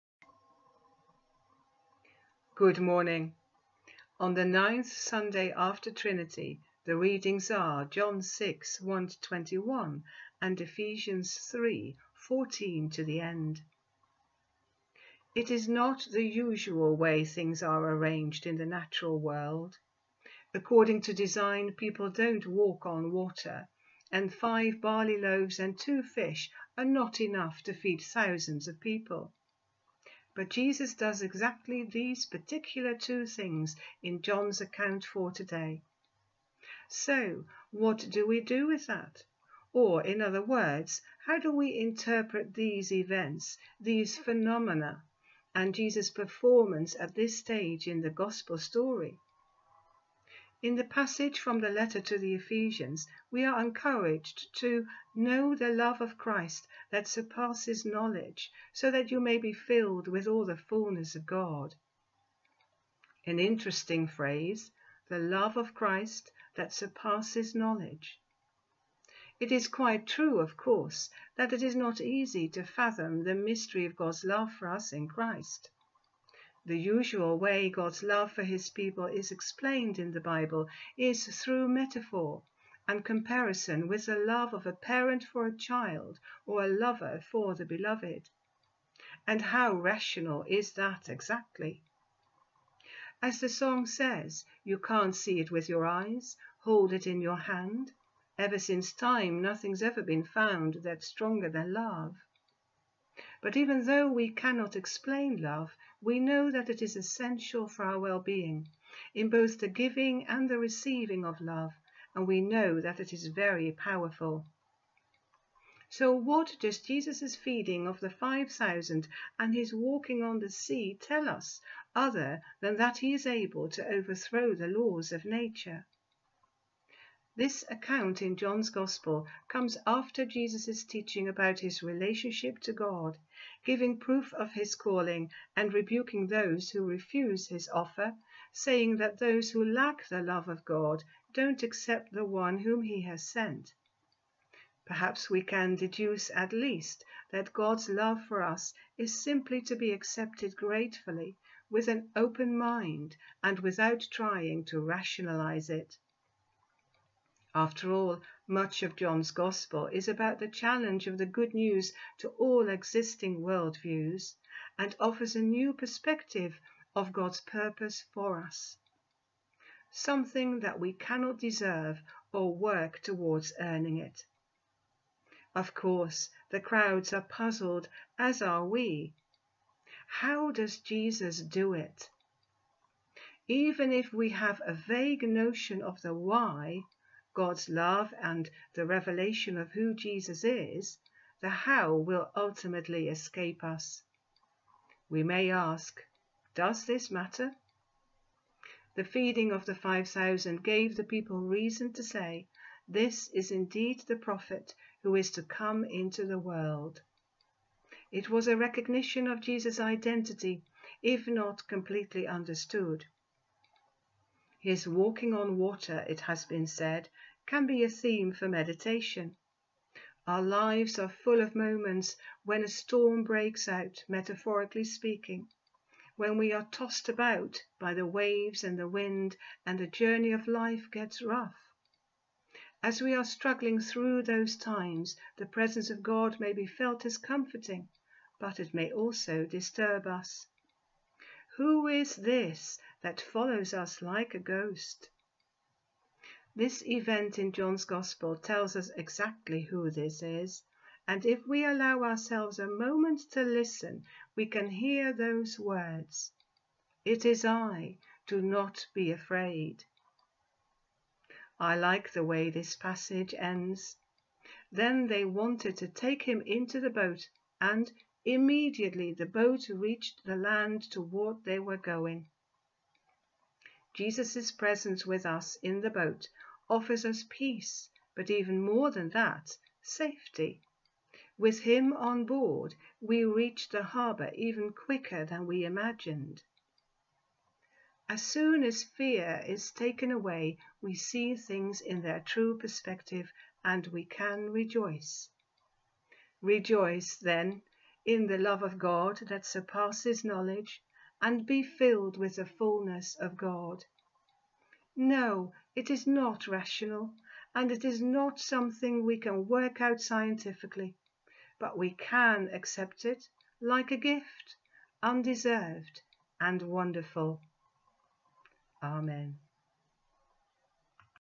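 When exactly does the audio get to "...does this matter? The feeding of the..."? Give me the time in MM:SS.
03:16.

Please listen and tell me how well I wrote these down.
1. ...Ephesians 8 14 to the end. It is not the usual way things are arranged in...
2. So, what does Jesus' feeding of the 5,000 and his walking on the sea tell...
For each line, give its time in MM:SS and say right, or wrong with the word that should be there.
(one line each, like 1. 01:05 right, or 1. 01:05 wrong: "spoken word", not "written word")
1. 00:10 wrong: "3", not "8"
2. 01:55 right.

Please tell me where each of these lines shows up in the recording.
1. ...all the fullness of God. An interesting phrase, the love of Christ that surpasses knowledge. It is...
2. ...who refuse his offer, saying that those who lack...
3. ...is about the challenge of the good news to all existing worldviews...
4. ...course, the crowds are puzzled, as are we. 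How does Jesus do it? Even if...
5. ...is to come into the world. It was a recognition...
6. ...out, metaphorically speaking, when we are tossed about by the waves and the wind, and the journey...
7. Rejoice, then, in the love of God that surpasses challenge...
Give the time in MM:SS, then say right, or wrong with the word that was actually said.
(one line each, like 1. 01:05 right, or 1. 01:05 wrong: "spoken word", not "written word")
1. 01:00 right
2. 02:16 right
3. 02:39 right
4. 02:55 right
5. 03:25 right
6. 03:43 right
7. 04:56 wrong: "knowledge", not "challenge".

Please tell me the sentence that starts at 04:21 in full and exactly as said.
I like the way this passage ends.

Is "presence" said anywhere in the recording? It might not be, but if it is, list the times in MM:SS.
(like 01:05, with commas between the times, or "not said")
03:55, 04:34.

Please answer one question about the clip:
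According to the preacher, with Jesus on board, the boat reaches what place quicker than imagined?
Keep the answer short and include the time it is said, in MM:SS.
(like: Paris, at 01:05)
The harbour, at 04:43.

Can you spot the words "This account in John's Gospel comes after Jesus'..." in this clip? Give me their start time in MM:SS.
02:07.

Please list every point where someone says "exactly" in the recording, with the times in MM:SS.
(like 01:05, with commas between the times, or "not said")
00:31, 01:31, 04:08.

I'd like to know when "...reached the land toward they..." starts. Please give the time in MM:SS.
04:29.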